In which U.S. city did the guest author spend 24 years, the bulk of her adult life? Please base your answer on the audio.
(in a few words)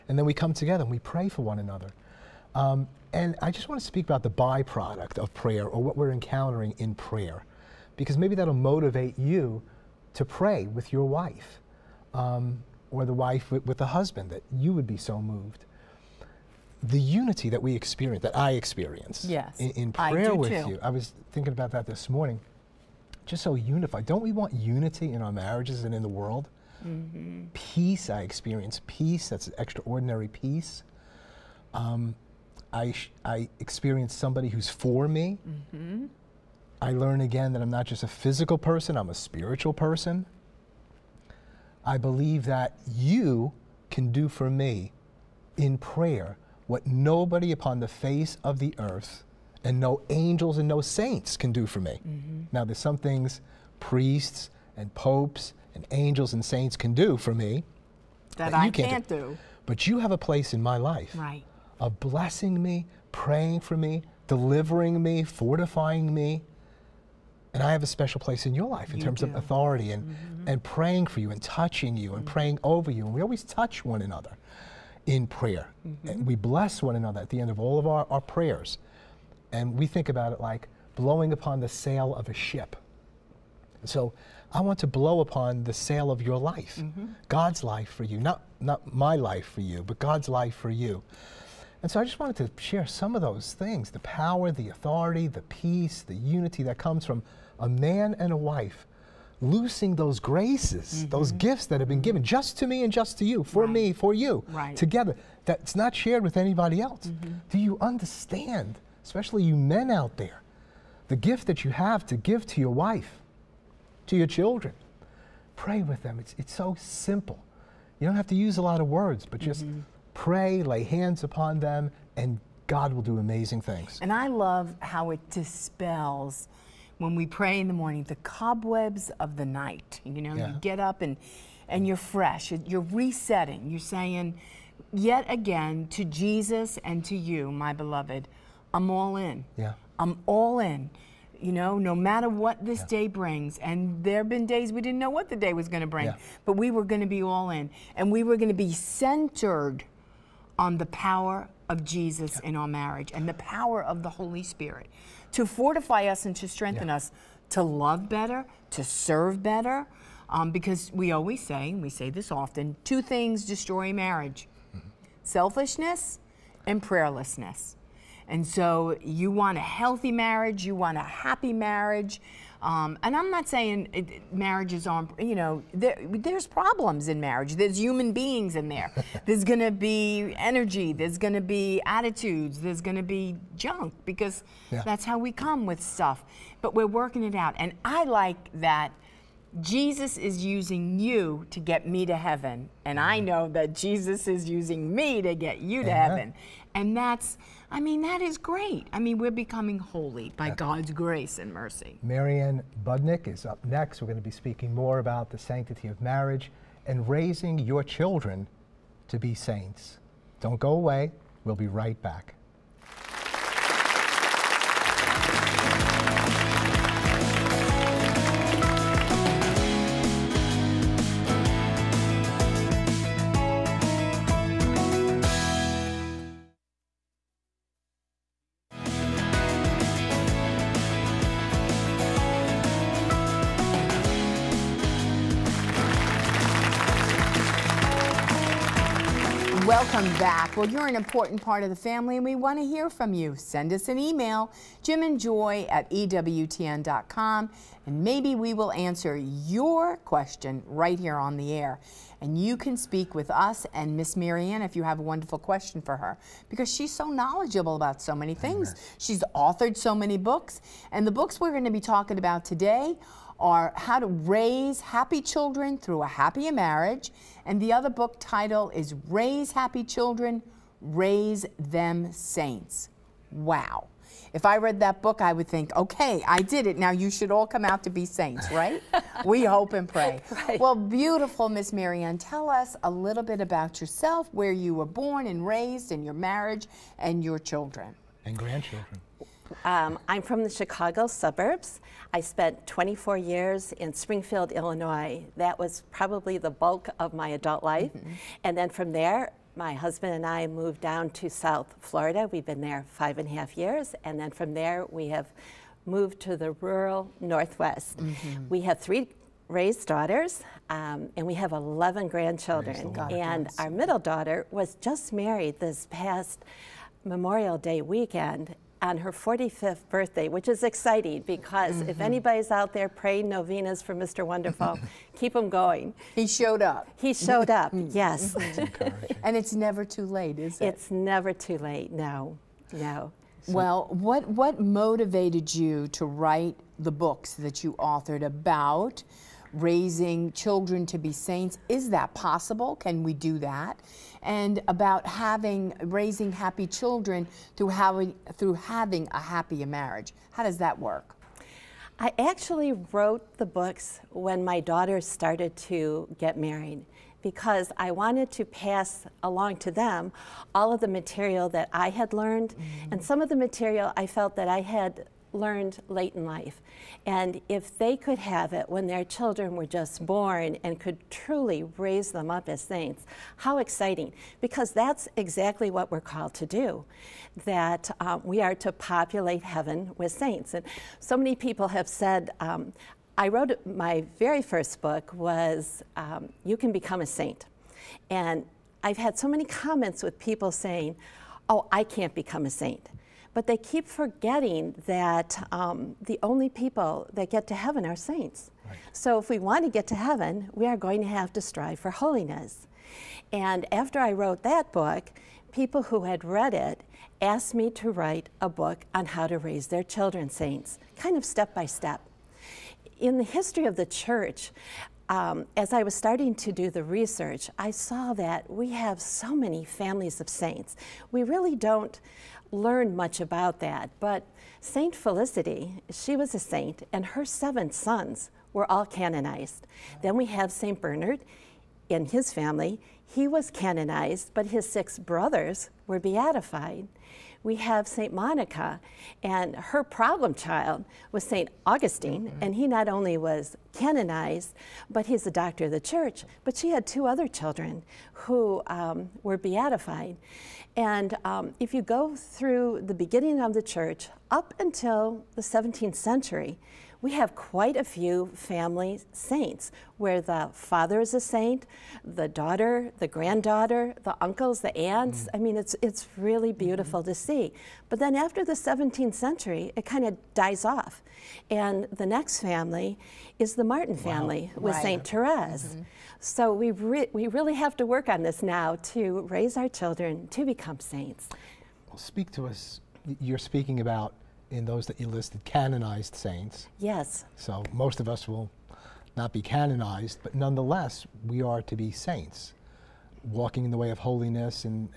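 Springfield, Illinois.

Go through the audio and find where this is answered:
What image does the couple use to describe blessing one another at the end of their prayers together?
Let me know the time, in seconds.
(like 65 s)
80 s.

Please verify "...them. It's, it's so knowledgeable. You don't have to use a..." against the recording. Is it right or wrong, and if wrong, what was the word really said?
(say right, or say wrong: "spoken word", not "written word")
wrong: "simple", not "knowledgeable".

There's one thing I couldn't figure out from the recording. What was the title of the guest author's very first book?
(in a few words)
You Can Become a Saint.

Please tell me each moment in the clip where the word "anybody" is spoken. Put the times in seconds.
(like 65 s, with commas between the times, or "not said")
106 s, 322 s.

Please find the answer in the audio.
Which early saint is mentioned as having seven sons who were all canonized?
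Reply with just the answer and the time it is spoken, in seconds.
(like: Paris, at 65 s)
Saint Felicity, at 424 s.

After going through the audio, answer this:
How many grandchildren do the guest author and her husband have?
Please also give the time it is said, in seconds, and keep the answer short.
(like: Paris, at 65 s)
11, at 311 s.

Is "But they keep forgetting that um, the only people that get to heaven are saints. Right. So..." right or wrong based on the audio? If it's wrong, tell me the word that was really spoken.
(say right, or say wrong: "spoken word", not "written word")
right.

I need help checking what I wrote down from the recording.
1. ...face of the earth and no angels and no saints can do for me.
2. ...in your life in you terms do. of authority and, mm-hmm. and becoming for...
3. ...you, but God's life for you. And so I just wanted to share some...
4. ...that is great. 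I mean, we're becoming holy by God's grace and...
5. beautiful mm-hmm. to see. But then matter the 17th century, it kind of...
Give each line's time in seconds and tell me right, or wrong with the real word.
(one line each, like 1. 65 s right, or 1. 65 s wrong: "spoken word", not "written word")
1. 47 s right
2. 68 s wrong: "praying", not "becoming"
3. 89 s right
4. 198 s right
5. 466 s wrong: "after", not "matter".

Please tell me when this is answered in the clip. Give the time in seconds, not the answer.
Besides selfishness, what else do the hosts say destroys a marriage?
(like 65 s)
166 s.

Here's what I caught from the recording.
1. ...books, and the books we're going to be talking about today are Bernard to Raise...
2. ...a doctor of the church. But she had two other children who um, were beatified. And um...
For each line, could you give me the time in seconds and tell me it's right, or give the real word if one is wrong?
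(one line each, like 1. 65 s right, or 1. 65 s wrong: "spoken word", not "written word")
1. 260 s wrong: "How", not "Bernard"
2. 445 s right.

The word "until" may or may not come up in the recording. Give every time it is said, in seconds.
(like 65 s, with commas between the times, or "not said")
454 s.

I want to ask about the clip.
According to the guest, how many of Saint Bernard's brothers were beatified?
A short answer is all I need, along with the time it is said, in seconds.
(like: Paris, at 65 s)
6, at 434 s.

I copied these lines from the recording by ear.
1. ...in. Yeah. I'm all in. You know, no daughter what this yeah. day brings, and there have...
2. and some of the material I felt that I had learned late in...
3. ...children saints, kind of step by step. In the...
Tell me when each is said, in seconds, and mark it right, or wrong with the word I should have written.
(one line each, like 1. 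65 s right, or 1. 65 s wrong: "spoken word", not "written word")
1. 139 s wrong: "matter", not "daughter"
2. 362 s right
3. 409 s right.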